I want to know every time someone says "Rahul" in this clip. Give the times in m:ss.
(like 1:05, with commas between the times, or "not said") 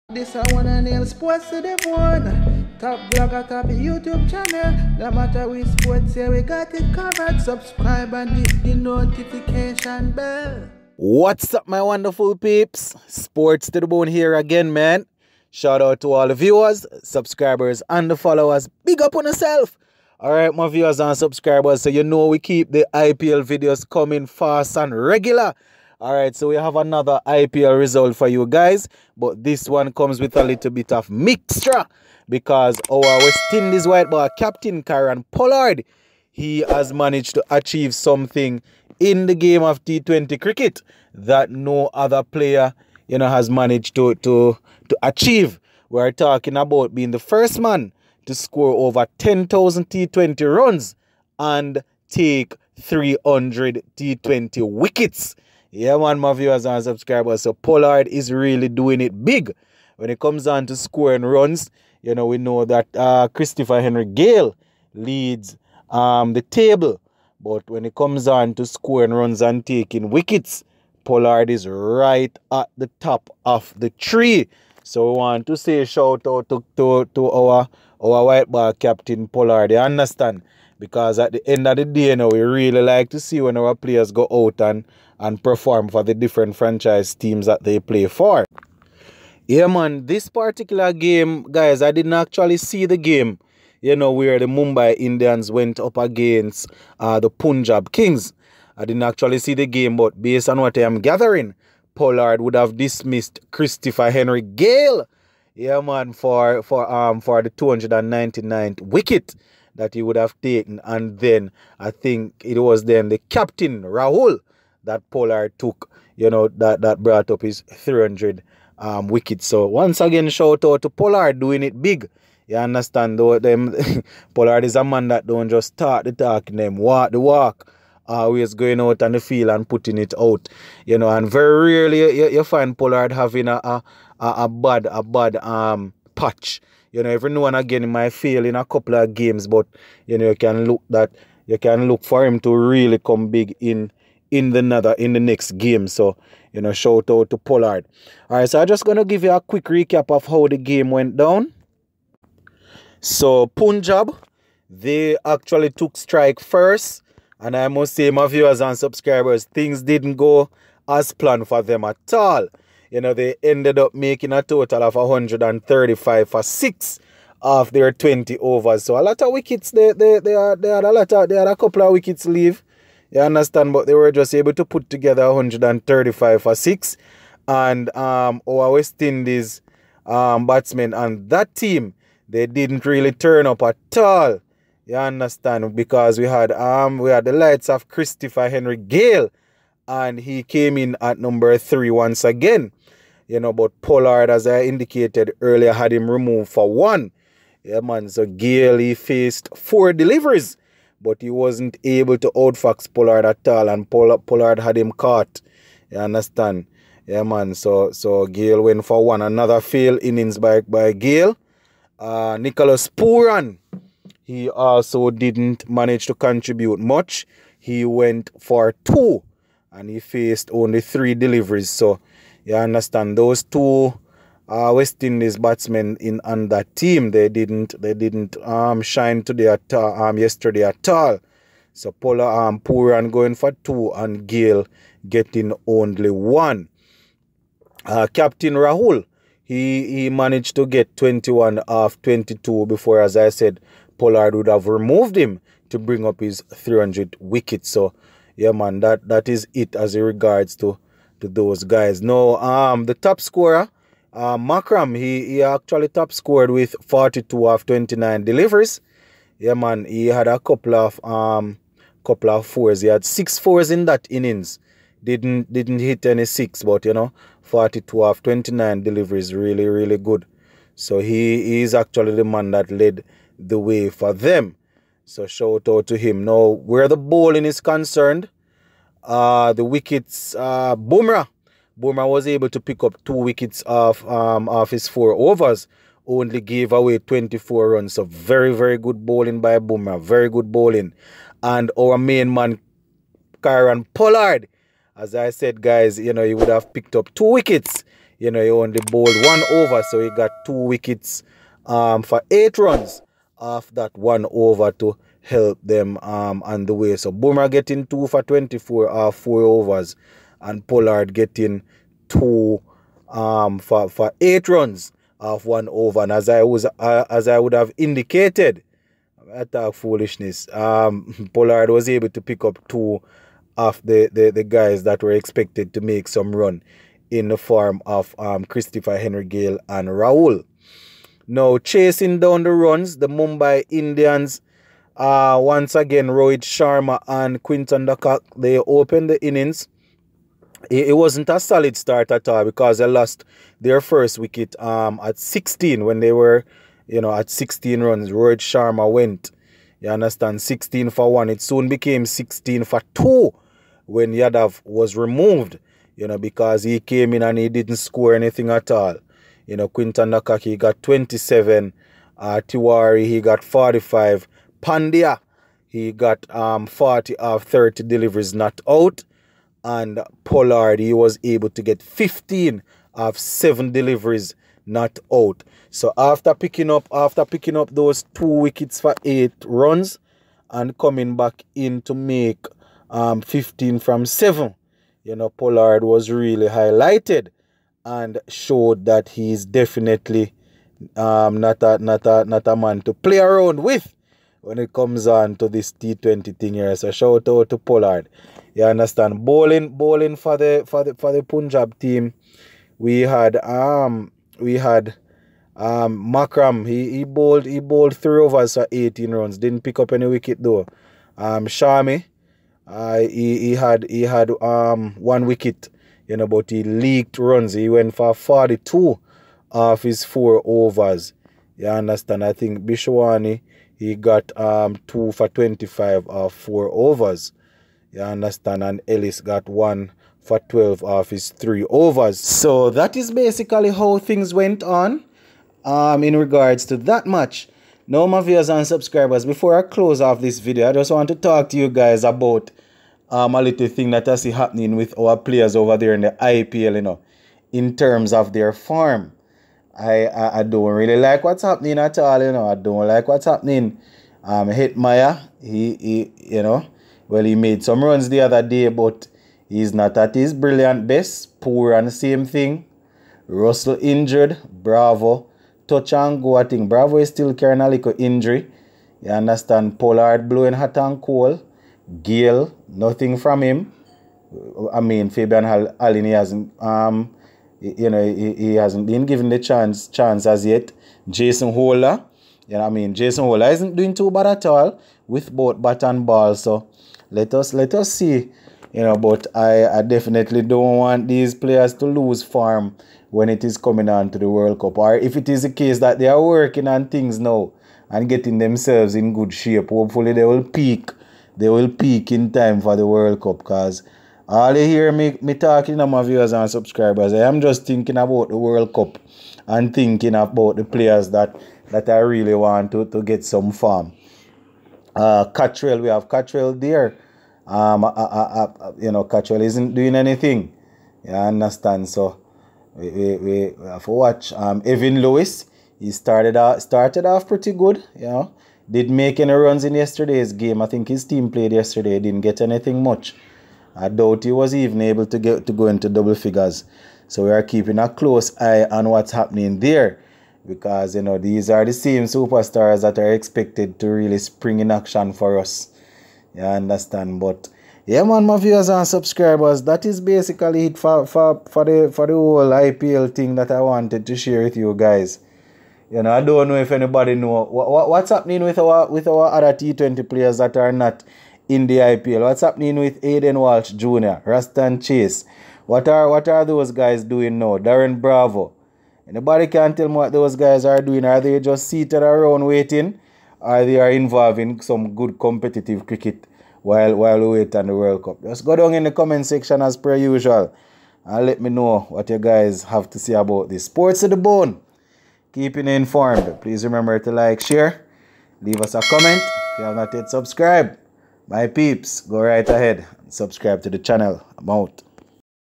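1:53, 3:58, 5:29.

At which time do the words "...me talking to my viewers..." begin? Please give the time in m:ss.
8:25.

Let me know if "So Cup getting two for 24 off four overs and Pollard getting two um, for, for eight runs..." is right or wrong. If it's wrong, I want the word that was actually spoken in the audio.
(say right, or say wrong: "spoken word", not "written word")
wrong: "Bumrah", not "Cup".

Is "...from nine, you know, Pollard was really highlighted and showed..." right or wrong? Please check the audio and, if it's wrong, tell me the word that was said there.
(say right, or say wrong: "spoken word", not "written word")
wrong: "seven", not "nine".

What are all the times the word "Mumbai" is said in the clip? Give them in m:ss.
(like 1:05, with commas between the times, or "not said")
1:34, 5:33.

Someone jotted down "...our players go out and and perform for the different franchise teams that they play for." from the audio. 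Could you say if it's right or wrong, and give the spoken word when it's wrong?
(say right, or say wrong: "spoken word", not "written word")
right.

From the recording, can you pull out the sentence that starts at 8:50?
I think his team played yesterday.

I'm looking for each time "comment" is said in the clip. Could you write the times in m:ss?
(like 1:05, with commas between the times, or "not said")
9:38, 9:48.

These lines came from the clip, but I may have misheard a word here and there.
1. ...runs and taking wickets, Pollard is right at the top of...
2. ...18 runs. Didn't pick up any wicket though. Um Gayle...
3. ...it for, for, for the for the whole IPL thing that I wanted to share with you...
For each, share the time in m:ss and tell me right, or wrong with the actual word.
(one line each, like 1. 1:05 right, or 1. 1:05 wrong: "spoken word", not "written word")
1. 1:09 right
2. 6:48 wrong: "Shami", not "Gayle"
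3. 9:10 right.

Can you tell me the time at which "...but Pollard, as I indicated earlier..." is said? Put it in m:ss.
3:13.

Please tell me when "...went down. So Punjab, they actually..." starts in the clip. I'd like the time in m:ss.
2:30.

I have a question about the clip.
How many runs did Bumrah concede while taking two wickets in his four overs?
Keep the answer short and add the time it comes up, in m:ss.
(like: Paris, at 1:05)
24, at 4:46.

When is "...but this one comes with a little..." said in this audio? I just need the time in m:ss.
0:29.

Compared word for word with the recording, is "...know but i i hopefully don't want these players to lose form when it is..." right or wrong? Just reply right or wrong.
wrong.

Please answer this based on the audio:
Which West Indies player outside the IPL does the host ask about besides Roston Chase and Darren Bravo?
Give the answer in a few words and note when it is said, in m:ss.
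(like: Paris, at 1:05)
Hayden Walsh Jr., at 9:23.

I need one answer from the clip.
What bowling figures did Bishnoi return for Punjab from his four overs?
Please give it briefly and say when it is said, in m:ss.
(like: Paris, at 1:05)
2 for 25, at 7:04.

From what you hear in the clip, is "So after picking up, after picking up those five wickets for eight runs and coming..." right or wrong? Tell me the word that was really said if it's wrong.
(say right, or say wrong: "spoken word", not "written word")
wrong: "two", not "five".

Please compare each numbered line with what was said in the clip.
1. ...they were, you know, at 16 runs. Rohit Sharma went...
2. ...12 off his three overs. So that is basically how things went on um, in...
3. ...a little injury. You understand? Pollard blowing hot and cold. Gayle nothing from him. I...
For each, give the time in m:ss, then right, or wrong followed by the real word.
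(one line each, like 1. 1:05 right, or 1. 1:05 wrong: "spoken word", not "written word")
1. 5:45 right
2. 7:10 right
3. 7:47 right.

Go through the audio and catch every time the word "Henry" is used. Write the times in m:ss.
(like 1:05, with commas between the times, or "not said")
1:03, 1:44, 3:08, 5:28.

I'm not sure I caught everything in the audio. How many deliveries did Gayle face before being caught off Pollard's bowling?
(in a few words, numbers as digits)
4.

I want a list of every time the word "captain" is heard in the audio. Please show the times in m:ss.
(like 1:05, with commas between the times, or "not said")
0:34, 1:18, 1:53, 3:58.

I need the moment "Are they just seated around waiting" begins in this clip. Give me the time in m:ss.
9:31.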